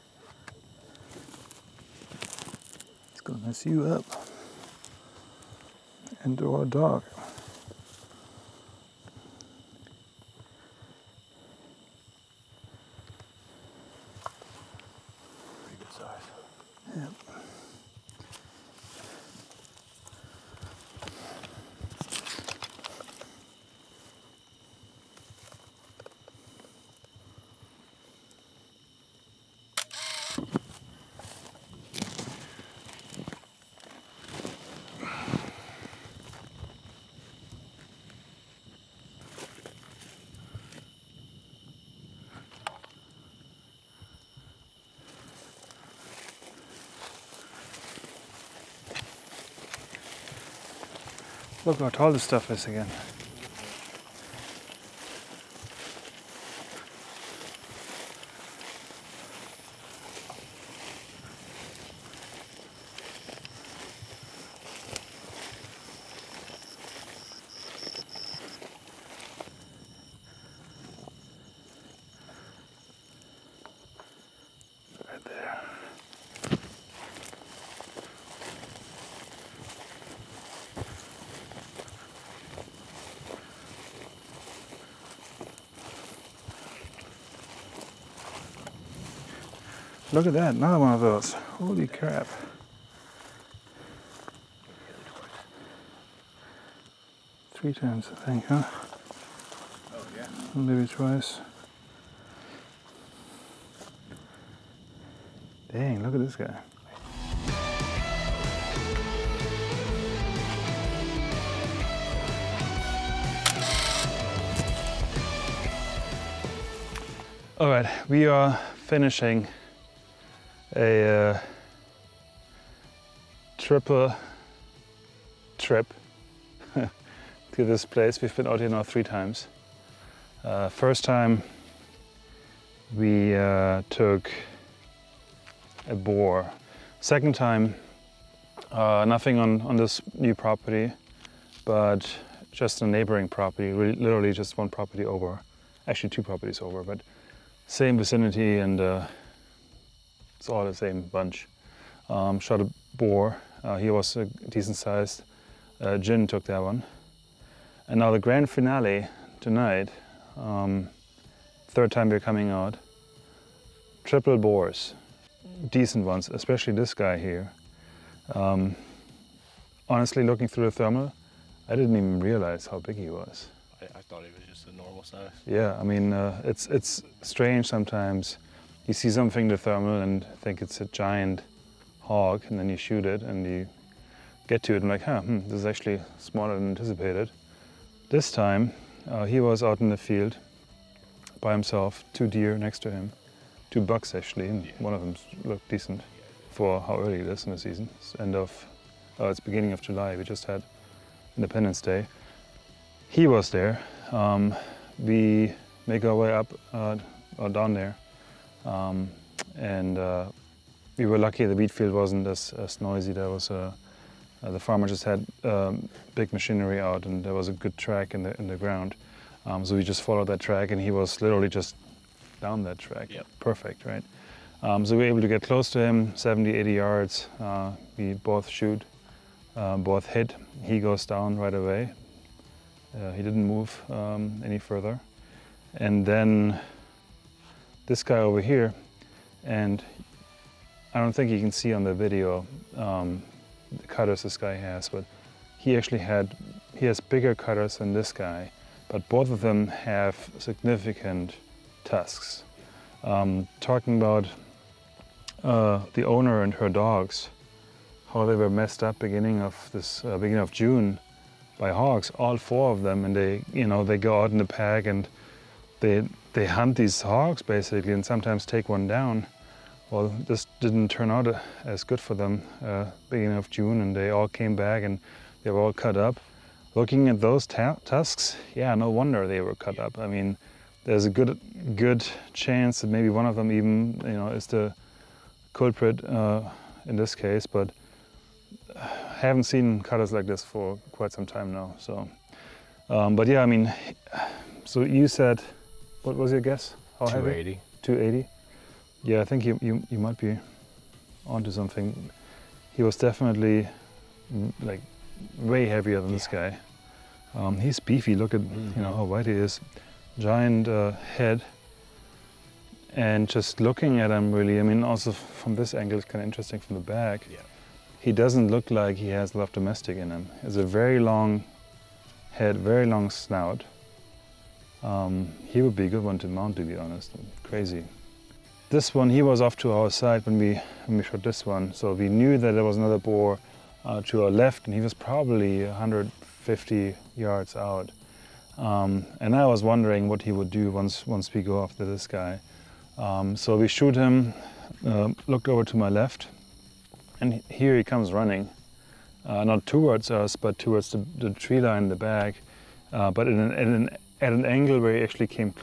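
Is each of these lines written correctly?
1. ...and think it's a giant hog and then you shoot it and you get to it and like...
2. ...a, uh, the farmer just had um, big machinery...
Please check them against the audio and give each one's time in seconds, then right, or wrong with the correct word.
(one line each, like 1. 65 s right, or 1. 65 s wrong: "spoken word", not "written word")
1. 180 s right
2. 213 s right.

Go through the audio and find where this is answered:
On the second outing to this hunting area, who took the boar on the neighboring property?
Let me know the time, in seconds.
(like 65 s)
155 s.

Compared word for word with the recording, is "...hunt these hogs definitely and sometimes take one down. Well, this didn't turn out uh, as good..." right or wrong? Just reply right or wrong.
wrong.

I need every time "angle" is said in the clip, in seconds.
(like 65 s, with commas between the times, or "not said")
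315 s, 354 s.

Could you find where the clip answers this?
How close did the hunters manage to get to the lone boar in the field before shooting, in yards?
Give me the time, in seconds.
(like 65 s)
226 s.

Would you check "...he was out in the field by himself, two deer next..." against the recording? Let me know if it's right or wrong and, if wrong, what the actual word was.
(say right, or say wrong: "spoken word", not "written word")
right.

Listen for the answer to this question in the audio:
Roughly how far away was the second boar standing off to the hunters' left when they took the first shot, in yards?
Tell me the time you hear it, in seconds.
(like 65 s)
335 s.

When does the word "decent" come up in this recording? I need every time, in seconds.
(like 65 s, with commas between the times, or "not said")
154 s, 165 s, 195 s.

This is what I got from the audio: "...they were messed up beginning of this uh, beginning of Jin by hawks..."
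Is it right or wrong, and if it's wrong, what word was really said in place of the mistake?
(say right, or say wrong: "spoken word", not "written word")
wrong: "June", not "Jin".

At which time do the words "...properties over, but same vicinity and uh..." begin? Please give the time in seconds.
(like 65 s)
146 s.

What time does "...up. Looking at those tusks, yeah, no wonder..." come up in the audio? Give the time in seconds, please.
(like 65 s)
275 s.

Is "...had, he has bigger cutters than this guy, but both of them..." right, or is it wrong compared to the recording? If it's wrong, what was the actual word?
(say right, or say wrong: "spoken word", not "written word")
right.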